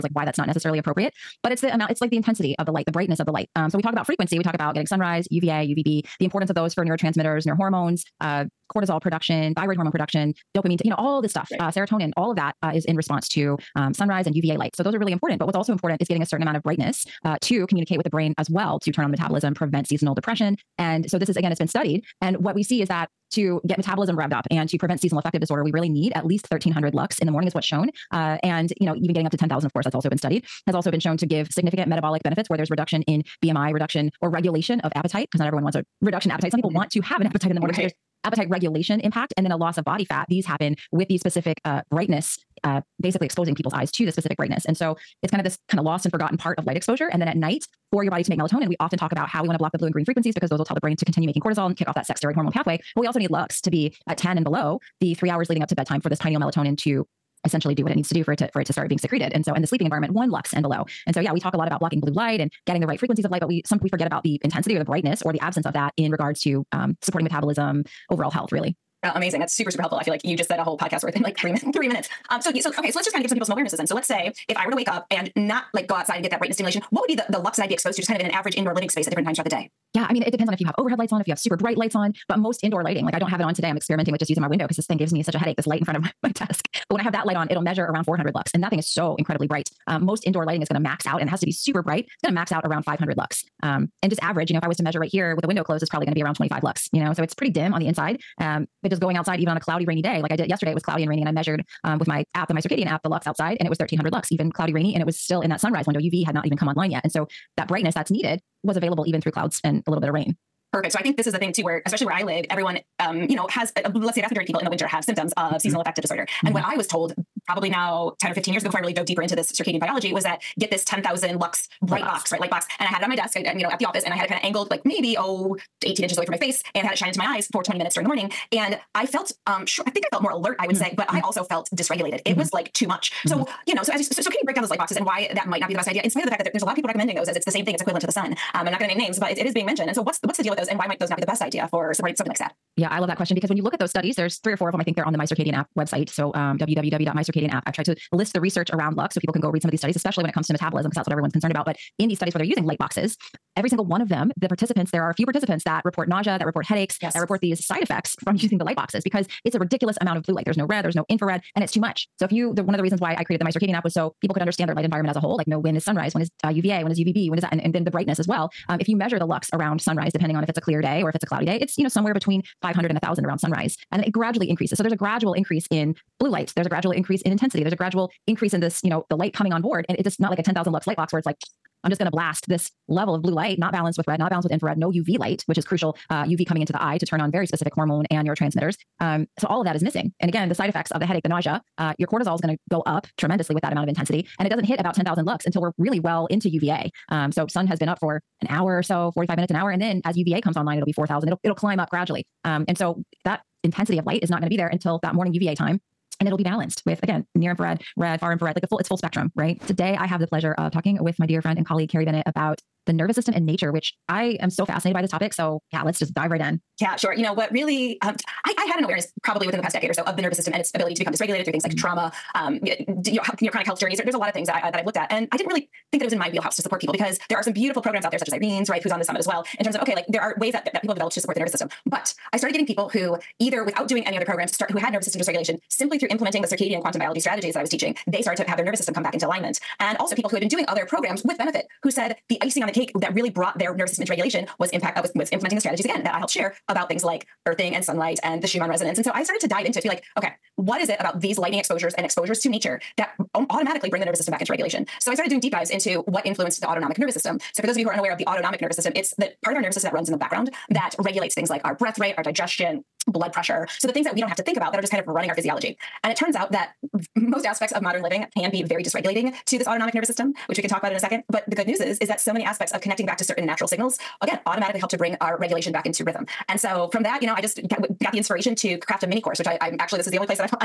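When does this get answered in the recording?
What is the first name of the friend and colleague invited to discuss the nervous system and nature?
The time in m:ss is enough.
3:31.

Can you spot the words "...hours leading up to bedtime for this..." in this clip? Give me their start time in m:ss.
0:55.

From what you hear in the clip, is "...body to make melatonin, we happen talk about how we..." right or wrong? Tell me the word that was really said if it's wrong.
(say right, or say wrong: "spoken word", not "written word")
wrong: "often", not "happen".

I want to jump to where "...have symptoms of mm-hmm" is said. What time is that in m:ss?
1:54.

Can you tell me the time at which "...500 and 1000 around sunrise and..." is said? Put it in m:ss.
2:52.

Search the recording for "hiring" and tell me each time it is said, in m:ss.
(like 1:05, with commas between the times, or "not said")
not said.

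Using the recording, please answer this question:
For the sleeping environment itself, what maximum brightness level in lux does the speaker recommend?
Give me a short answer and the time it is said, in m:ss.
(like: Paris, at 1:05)
1 lux, at 1:00.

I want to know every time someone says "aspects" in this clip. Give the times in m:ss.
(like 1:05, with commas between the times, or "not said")
4:27, 4:32.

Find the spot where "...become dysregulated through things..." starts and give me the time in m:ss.
3:40.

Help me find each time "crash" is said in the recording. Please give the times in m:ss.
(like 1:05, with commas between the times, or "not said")
not said.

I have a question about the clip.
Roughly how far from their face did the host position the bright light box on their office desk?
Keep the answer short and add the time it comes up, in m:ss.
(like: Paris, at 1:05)
18 inches, at 2:05.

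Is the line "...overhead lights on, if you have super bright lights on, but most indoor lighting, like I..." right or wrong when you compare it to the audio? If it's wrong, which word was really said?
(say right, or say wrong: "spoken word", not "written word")
right.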